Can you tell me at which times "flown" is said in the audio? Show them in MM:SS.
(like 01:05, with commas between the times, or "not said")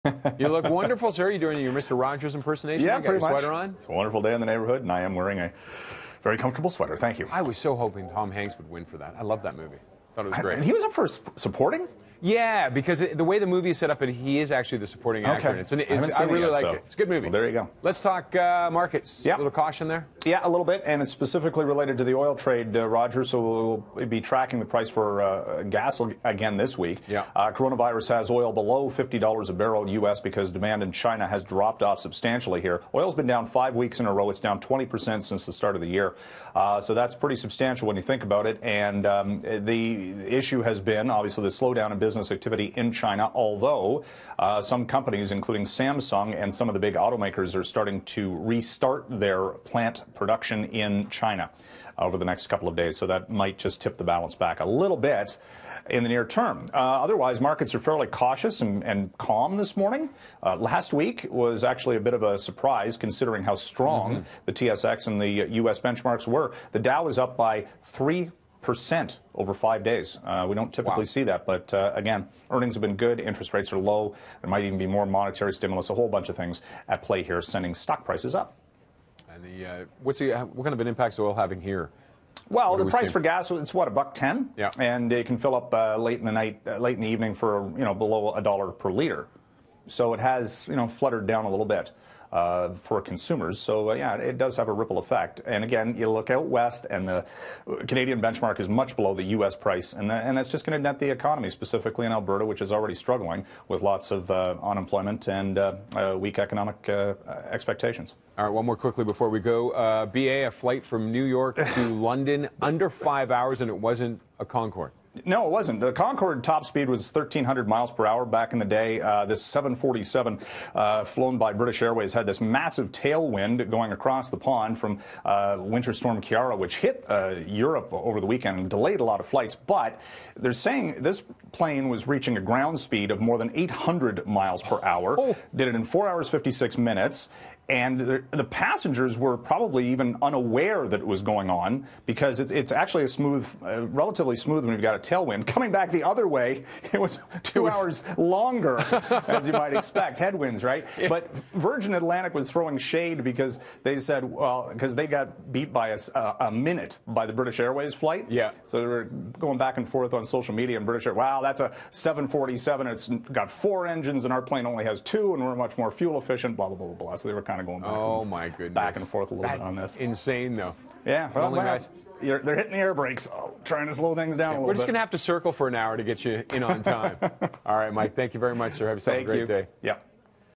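02:01.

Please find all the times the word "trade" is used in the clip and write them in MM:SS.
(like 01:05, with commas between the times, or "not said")
00:22.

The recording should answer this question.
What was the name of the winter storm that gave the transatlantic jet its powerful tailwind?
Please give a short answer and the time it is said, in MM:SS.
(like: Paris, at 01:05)
Kiara, at 02:06.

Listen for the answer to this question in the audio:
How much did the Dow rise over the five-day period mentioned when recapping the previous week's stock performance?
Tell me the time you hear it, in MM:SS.
01:07.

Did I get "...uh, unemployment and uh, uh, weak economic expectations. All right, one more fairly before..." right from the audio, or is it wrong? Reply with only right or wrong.
wrong.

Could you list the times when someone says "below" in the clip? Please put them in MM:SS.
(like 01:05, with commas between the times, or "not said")
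00:28, 01:27, 01:38.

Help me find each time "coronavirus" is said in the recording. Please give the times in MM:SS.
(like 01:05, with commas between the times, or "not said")
00:27.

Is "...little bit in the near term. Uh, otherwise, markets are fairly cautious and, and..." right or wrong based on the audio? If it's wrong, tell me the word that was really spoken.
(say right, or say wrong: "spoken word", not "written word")
right.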